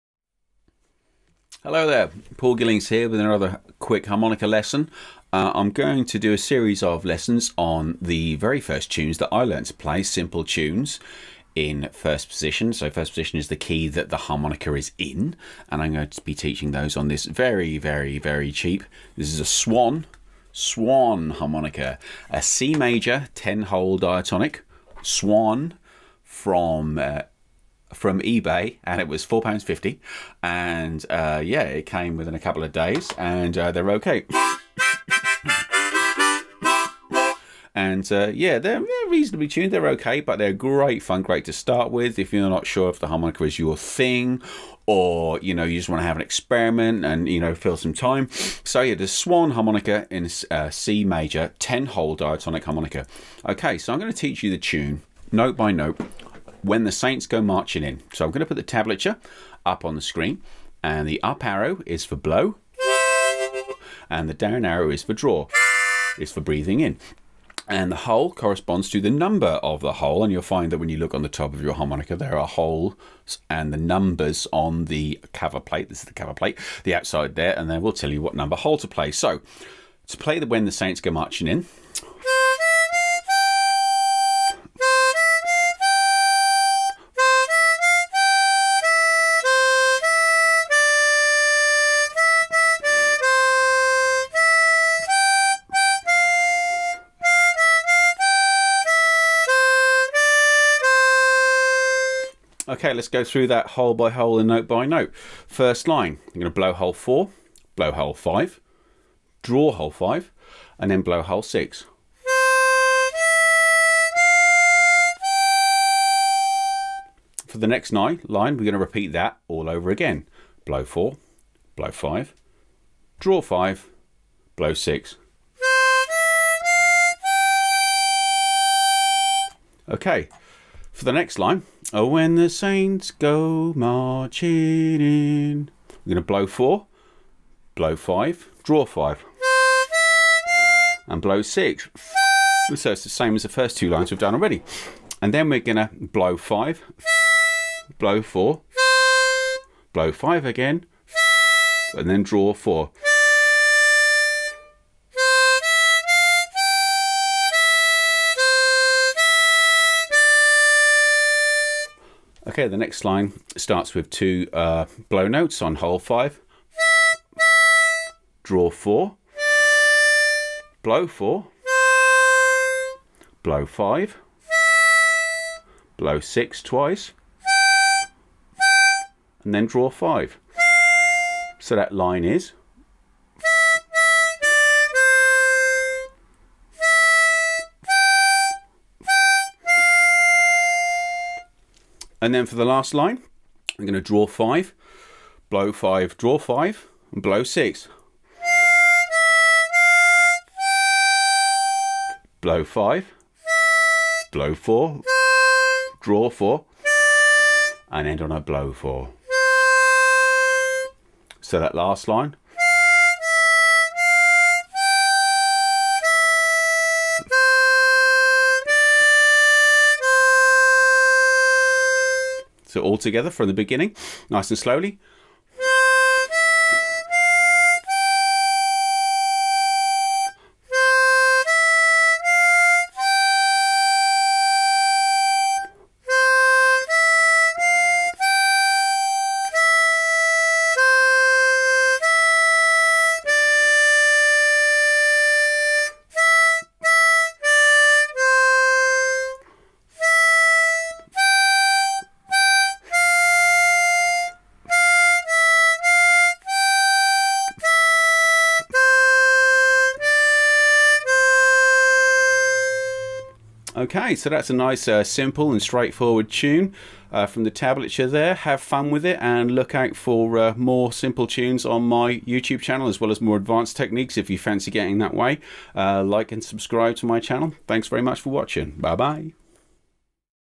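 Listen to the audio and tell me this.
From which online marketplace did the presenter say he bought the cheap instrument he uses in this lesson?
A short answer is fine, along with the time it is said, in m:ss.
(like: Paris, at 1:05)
eBay, at 0:28.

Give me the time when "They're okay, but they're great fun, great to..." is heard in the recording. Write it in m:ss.
0:39.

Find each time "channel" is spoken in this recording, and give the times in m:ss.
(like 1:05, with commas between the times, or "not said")
4:32, 4:37.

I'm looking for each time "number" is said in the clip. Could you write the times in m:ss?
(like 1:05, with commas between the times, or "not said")
1:09, 1:13, 1:18.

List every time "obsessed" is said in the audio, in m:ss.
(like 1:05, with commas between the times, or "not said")
not said.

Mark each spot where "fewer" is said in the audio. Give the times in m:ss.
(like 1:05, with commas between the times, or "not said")
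not said.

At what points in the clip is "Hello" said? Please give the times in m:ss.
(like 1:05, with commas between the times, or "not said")
0:01.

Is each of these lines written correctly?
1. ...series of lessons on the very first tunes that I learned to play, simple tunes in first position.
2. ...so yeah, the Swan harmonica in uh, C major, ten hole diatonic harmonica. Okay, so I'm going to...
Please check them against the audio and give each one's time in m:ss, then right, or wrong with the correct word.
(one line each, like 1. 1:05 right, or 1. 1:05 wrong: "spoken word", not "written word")
1. 0:06 right
2. 0:48 right.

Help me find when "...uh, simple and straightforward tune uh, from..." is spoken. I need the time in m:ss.
4:24.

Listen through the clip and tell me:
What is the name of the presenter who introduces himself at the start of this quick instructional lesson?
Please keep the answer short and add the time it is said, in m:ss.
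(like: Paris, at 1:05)
Paul Gillings, at 0:02.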